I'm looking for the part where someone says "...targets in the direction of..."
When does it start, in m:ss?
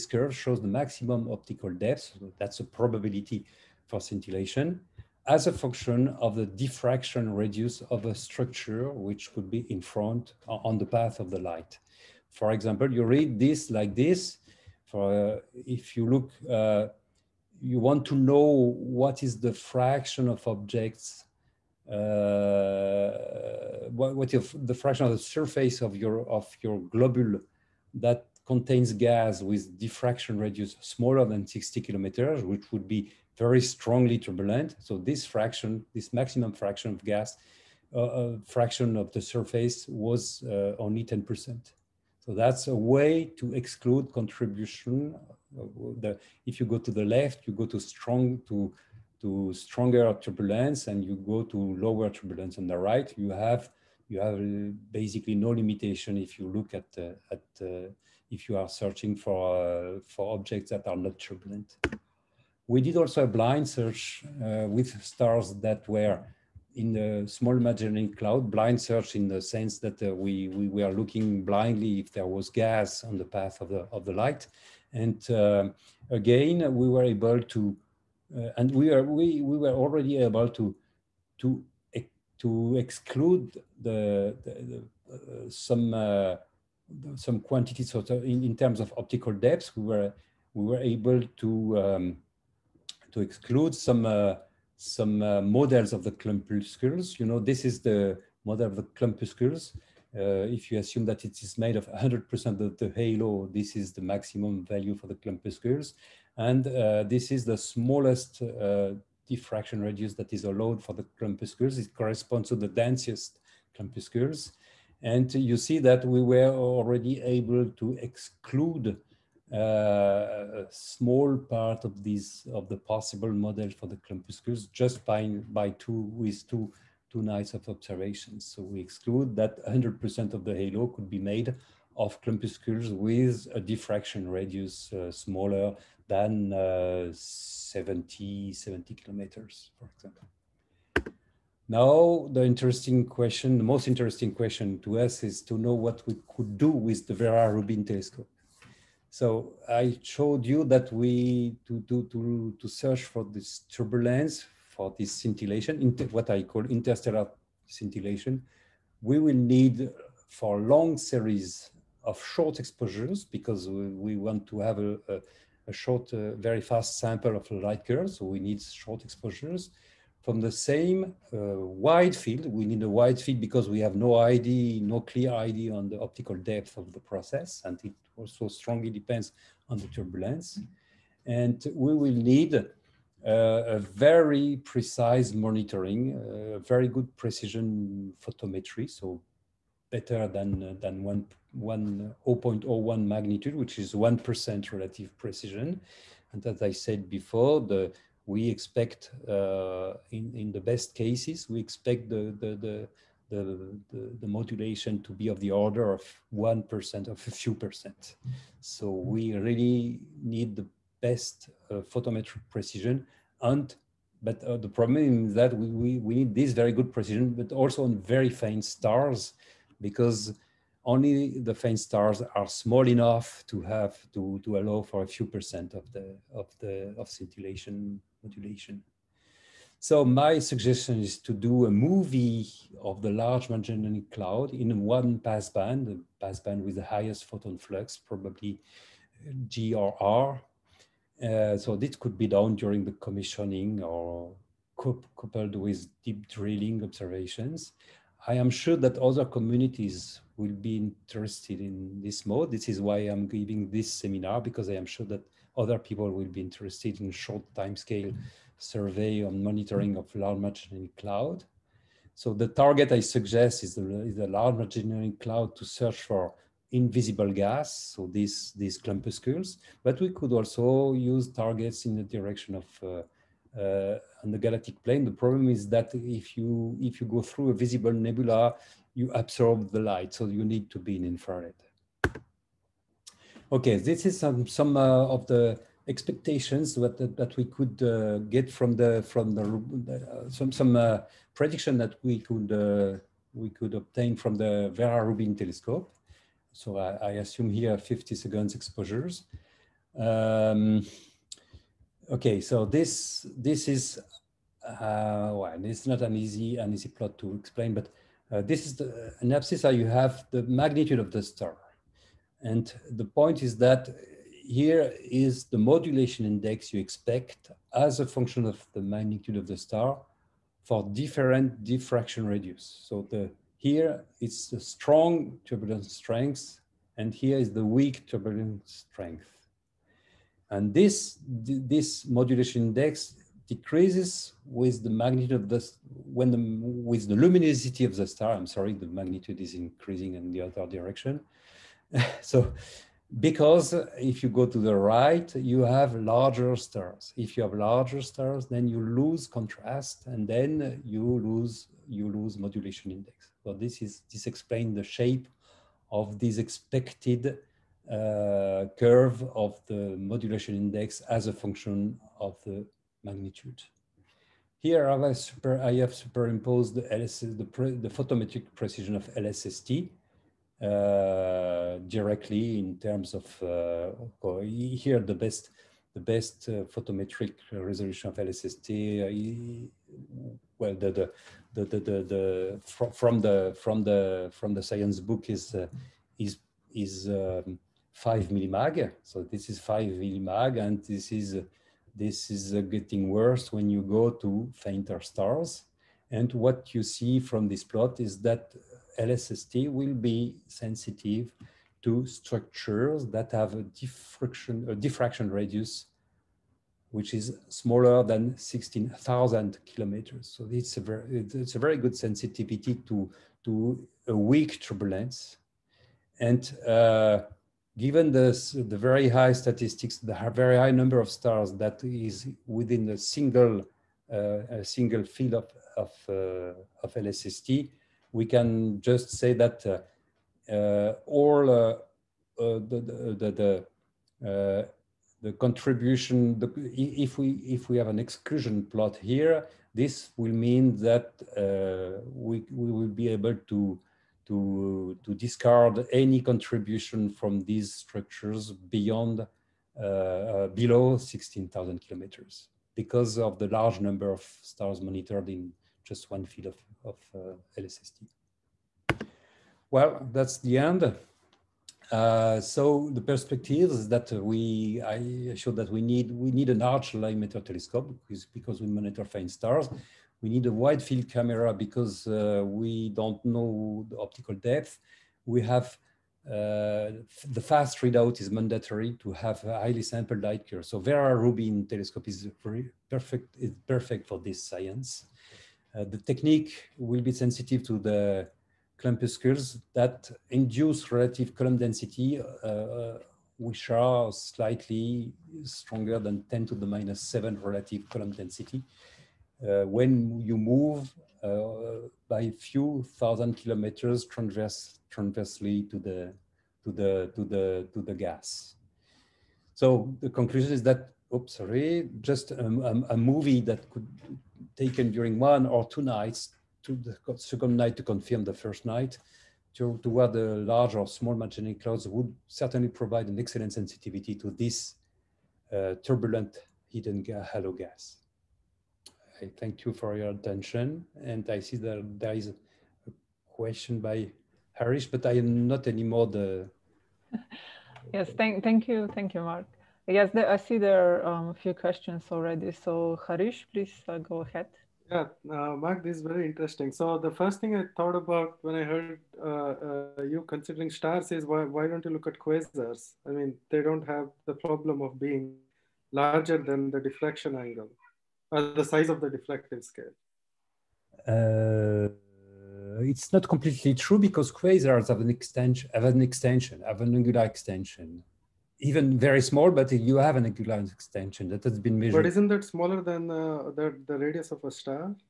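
4:31.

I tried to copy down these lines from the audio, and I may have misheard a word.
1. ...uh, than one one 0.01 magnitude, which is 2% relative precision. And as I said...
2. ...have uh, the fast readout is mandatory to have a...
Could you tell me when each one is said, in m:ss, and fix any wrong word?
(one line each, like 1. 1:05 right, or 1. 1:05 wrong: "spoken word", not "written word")
1. 3:10 wrong: "1", not "2"
2. 7:55 right.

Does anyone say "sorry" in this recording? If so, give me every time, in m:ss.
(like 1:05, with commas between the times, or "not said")
5:38, 8:31.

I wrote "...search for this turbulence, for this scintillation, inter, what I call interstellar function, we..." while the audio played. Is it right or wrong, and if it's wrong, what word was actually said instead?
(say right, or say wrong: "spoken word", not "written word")
wrong: "scintillation", not "function".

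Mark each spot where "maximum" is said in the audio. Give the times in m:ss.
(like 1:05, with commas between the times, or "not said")
0:00, 0:36, 1:44.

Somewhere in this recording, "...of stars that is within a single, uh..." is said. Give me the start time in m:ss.
7:00.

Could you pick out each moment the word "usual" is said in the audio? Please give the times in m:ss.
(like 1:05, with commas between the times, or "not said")
not said.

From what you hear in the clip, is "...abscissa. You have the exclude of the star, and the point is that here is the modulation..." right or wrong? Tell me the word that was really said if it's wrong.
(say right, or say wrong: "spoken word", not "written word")
wrong: "magnitude", not "exclude".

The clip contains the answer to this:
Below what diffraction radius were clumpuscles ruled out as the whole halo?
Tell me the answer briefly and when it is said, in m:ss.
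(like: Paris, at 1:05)
70 kilometers, at 2:18.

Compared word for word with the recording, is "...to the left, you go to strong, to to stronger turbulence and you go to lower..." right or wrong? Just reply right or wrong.
right.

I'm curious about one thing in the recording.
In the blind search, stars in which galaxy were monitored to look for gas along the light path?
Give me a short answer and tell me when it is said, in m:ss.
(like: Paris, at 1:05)
Small Magellanic Cloud, at 1:07.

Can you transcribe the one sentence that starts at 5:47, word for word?
If you have larger stars, then you lose contrast and then you lose, you lose modulation index.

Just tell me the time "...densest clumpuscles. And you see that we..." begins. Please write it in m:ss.
1:52.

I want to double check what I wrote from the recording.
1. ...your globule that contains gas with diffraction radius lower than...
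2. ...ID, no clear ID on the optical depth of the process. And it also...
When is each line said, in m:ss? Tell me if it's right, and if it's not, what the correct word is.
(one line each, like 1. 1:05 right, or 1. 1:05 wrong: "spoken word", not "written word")
1. 0:26 wrong: "smaller", not "lower"
2. 2:54 right.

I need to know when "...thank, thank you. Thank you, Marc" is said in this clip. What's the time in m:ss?
8:58.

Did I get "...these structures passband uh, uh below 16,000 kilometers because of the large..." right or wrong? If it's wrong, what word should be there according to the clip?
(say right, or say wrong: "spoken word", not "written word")
wrong: "beyond", not "passband".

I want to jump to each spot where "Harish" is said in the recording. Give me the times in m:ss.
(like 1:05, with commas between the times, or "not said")
8:54, 9:03.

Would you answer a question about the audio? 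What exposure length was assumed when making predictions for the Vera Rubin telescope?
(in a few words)
50 seconds.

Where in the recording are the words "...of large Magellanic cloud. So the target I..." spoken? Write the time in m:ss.
4:19.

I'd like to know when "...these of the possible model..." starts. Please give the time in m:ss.
2:02.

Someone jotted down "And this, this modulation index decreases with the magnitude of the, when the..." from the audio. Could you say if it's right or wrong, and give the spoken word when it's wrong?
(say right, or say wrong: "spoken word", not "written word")
right.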